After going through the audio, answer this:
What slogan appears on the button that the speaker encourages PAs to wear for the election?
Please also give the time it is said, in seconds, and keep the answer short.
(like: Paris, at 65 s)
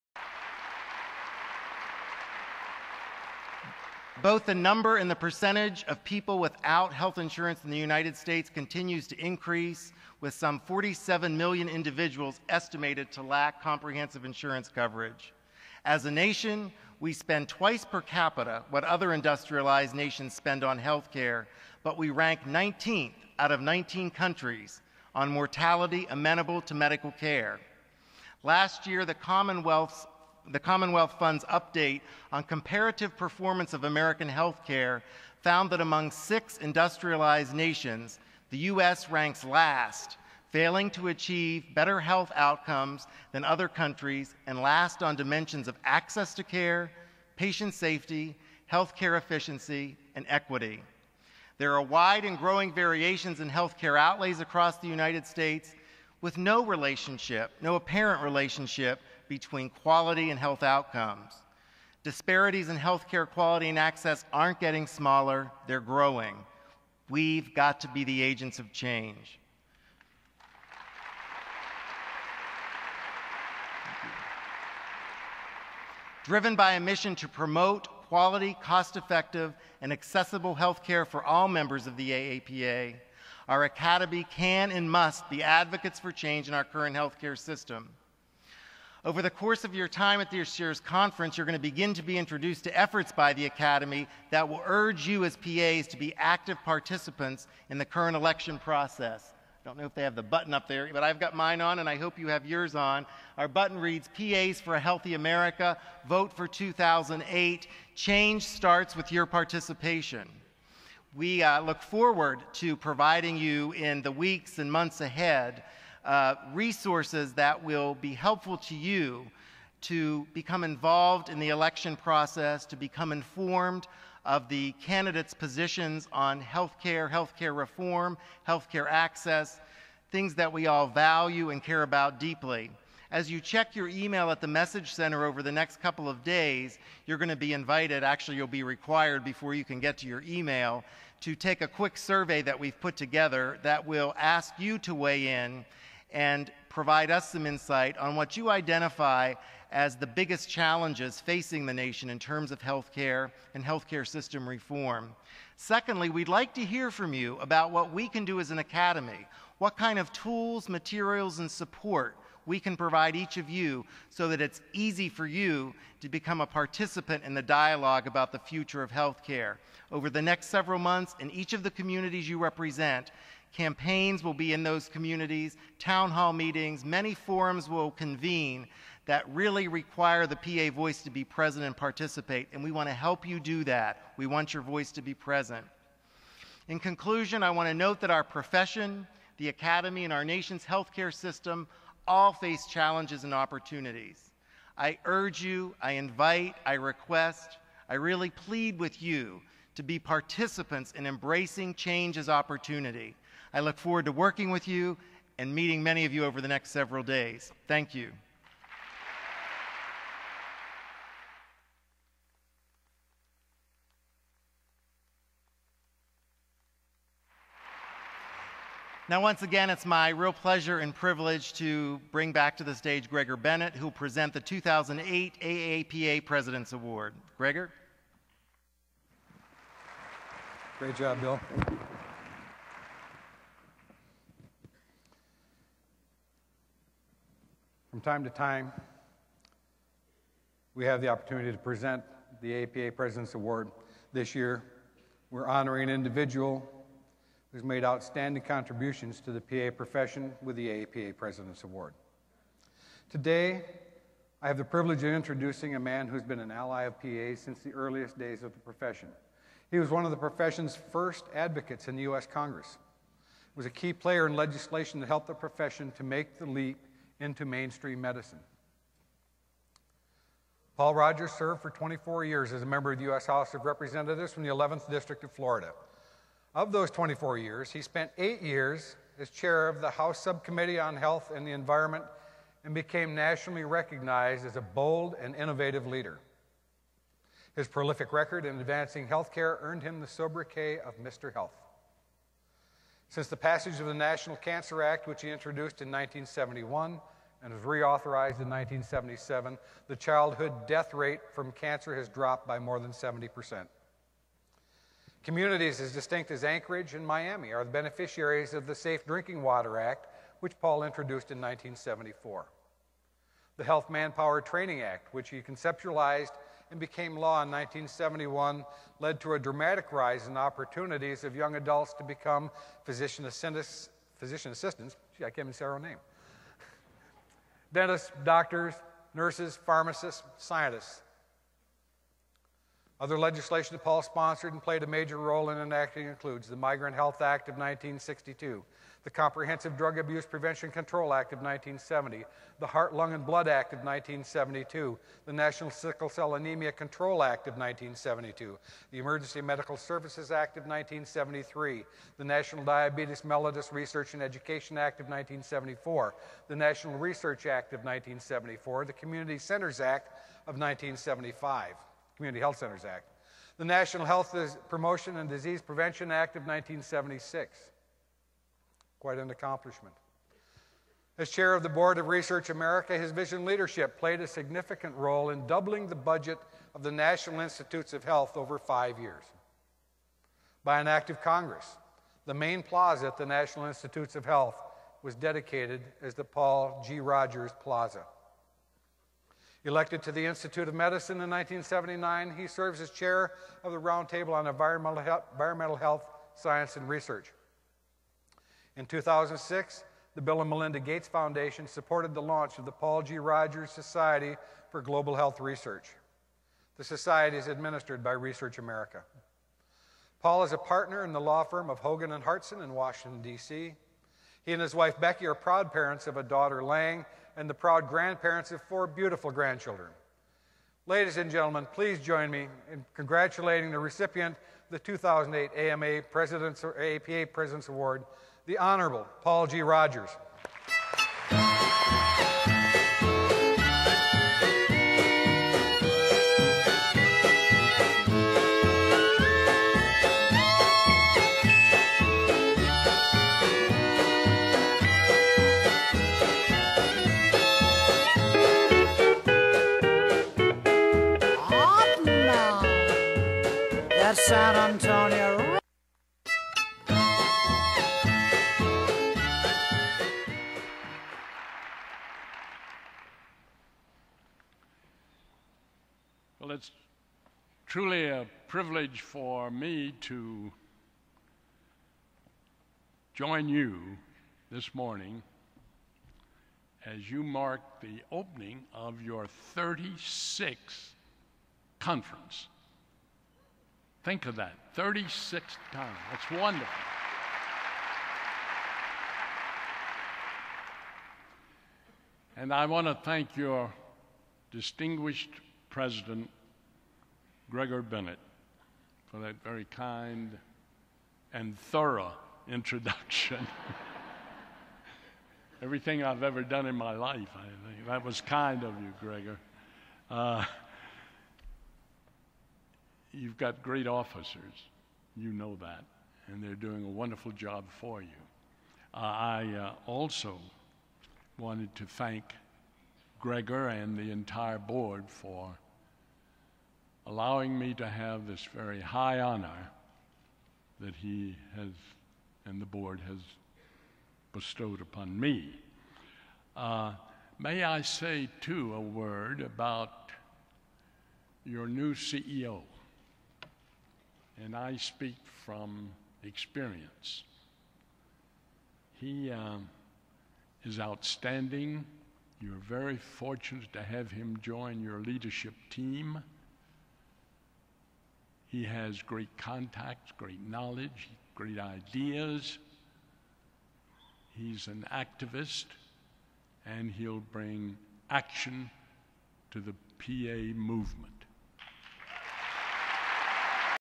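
PAs for a Healthy America, at 104 s.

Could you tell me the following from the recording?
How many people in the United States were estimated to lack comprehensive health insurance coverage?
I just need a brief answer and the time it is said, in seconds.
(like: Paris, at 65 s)
47 million, at 10 s.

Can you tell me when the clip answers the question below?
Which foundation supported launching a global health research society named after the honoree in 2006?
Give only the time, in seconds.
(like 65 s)
400 s.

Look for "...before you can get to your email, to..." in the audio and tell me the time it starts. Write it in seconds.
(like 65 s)
139 s.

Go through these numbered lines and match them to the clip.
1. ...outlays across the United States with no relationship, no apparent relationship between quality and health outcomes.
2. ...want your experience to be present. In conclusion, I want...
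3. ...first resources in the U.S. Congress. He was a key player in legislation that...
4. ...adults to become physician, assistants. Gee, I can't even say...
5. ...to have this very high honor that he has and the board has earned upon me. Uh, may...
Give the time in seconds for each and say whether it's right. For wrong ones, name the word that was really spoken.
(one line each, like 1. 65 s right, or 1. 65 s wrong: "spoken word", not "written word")
1. 53 s right
2. 184 s wrong: "voice", not "experience"
3. 260 s wrong: "advocates", not "resources"
4. 321 s right
5. 527 s wrong: "bestowed", not "earned".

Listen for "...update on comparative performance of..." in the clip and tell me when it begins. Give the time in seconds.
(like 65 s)
31 s.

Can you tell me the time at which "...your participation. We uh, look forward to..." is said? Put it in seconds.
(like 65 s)
109 s.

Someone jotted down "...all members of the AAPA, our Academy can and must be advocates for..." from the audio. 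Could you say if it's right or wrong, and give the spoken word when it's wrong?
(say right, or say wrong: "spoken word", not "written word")
right.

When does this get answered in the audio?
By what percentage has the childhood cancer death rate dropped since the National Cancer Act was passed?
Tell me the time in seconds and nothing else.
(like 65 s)
302 s.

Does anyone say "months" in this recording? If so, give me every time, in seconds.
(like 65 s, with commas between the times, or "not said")
114 s, 170 s.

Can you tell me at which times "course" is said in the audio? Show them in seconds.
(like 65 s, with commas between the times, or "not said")
89 s.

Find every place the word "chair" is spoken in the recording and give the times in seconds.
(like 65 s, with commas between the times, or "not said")
279 s, 371 s, 392 s.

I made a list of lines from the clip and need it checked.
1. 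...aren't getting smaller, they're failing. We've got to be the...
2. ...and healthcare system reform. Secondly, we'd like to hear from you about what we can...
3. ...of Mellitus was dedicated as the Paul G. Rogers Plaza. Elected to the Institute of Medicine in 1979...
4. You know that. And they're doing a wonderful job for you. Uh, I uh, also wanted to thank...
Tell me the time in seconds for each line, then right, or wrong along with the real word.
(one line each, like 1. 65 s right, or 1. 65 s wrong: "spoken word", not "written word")
1. 64 s wrong: "growing", not "failing"
2. 153 s right
3. 384 s wrong: "Health", not "Mellitus"
4. 515 s right.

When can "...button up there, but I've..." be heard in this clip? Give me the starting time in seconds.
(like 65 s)
100 s.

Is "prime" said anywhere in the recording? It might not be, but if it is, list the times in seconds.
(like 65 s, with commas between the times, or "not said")
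not said.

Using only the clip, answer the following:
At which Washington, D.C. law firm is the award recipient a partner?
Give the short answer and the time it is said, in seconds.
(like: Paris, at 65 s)
Hogan and Hartson, at 411 s.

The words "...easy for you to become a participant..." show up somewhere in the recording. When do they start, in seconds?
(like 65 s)
164 s.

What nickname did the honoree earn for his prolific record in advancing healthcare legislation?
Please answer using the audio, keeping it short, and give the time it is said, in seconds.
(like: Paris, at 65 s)
Mr. Health, at 291 s.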